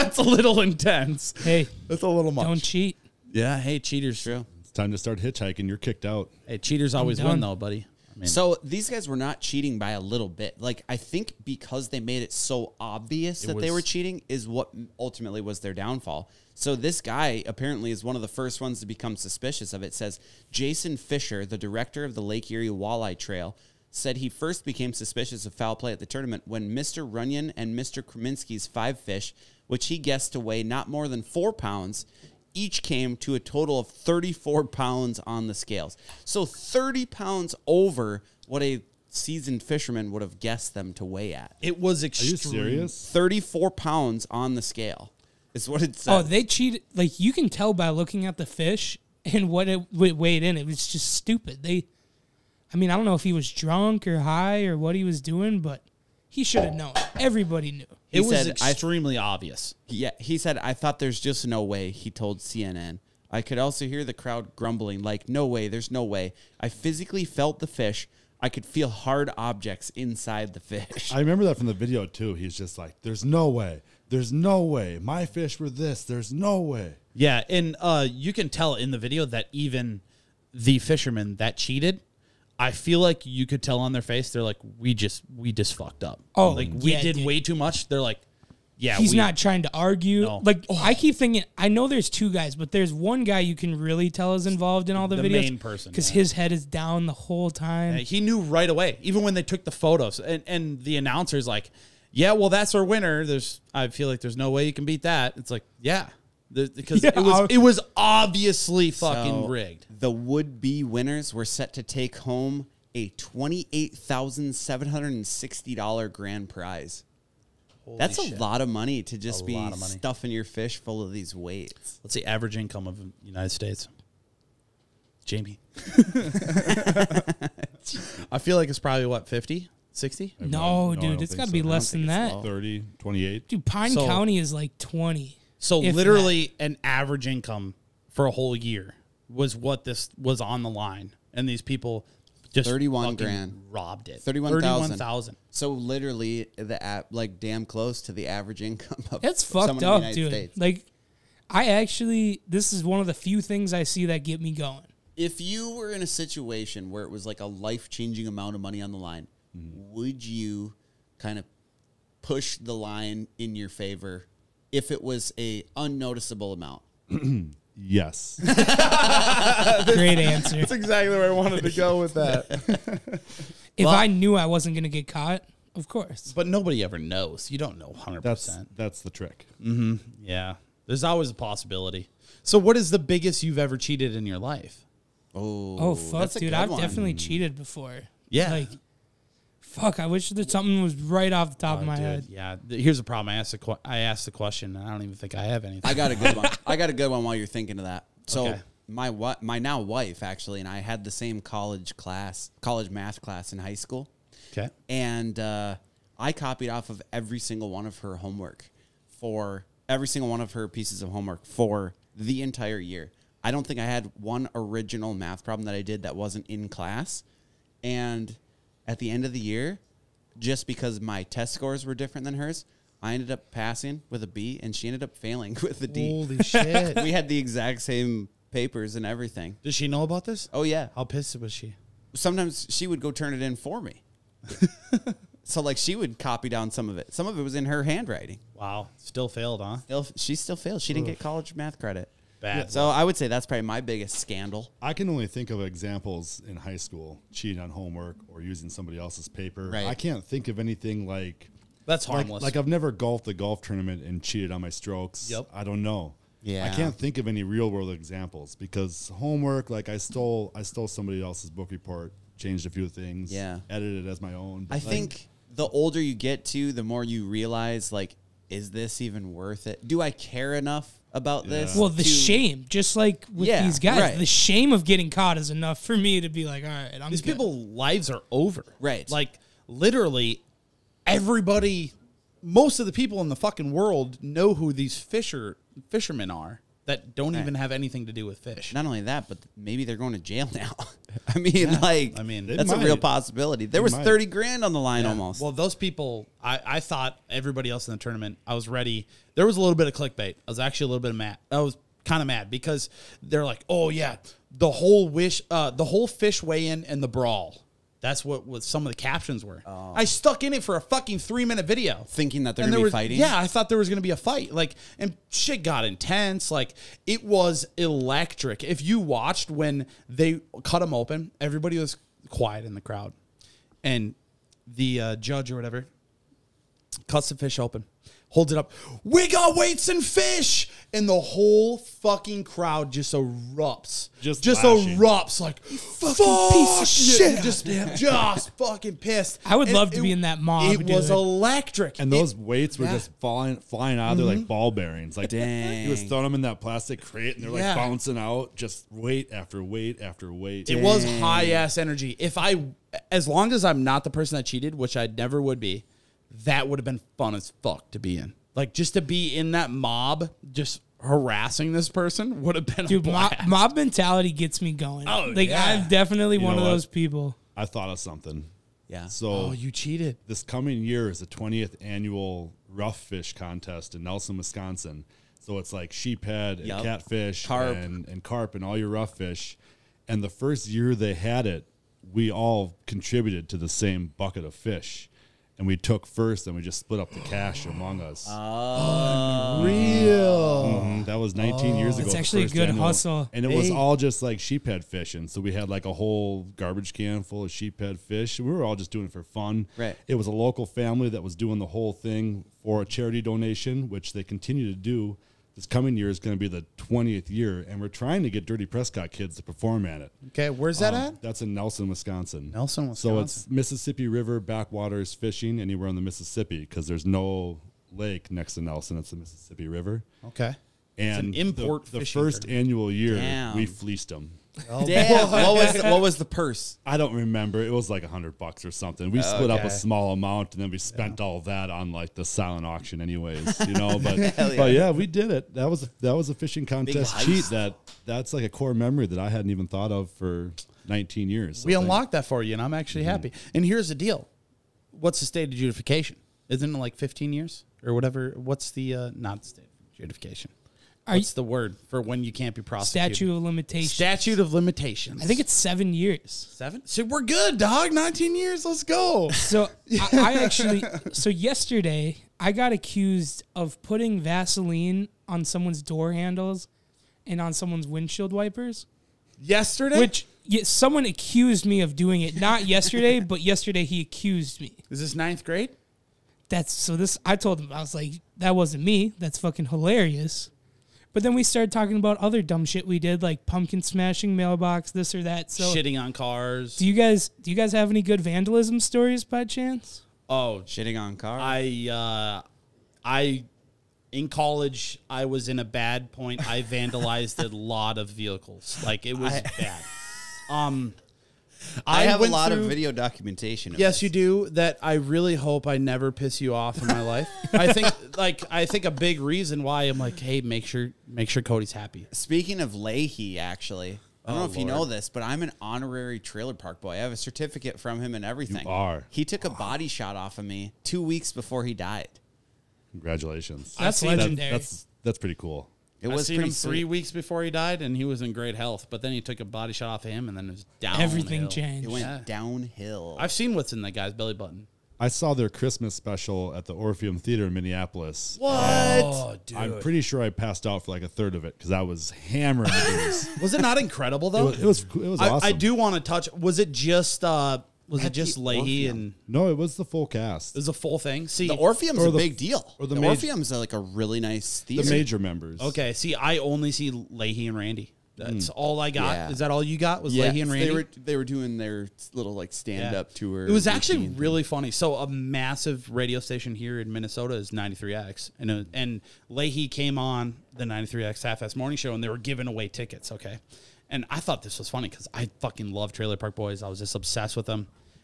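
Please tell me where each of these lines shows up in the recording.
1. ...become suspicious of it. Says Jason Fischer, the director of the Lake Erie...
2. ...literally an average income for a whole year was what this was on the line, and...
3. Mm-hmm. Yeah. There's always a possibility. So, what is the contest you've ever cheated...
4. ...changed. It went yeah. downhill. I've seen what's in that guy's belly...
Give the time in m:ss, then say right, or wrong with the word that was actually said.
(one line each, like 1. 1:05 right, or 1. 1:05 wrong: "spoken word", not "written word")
1. 0:18 right
2. 2:15 right
3. 2:59 wrong: "biggest", not "contest"
4. 8:51 right.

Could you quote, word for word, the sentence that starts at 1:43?
There's, I feel like there's no way you can beat that.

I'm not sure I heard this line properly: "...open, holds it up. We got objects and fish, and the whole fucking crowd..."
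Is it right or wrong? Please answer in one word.
wrong.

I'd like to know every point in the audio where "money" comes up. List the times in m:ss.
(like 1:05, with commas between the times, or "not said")
1:58, 2:38.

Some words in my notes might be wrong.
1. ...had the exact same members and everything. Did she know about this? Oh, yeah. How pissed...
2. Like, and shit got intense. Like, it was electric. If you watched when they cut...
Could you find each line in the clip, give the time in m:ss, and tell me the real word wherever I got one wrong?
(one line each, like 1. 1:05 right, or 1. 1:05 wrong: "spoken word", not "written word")
1. 3:47 wrong: "papers", not "members"
2. 5:14 right.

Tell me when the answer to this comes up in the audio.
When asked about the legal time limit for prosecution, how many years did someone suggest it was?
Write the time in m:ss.
7:35.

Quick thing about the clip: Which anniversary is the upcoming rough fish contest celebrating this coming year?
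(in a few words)
20th.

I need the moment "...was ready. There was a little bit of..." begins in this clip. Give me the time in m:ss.
4:58.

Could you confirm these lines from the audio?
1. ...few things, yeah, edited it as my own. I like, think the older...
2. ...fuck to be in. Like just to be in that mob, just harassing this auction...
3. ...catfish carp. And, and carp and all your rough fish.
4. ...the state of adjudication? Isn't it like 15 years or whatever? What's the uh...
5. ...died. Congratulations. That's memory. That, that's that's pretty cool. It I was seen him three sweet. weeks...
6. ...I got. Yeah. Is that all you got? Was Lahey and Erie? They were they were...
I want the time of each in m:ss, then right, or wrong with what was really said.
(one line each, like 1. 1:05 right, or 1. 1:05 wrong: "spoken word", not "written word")
1. 4:22 right
2. 5:57 wrong: "person", not "auction"
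3. 6:16 right
4. 7:25 right
5. 8:41 wrong: "legendary", not "memory"
6. 9:18 wrong: "Randy", not "Erie".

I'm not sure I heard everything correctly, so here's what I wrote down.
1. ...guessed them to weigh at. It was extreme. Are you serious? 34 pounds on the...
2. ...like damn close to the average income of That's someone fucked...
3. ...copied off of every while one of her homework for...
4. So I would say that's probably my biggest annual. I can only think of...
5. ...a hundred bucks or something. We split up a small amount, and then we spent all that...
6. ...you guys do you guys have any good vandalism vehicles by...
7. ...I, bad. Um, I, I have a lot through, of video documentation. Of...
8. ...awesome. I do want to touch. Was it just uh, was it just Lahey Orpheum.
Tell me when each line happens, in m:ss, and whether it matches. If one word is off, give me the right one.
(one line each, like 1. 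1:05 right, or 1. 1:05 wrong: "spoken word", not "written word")
1. 0:40 right
2. 2:27 right
3. 3:26 wrong: "single", not "while"
4. 4:02 wrong: "scandal", not "annual"
5. 7:08 right
6. 8:06 wrong: "stories", not "vehicles"
7. 8:19 right
8. 9:05 right.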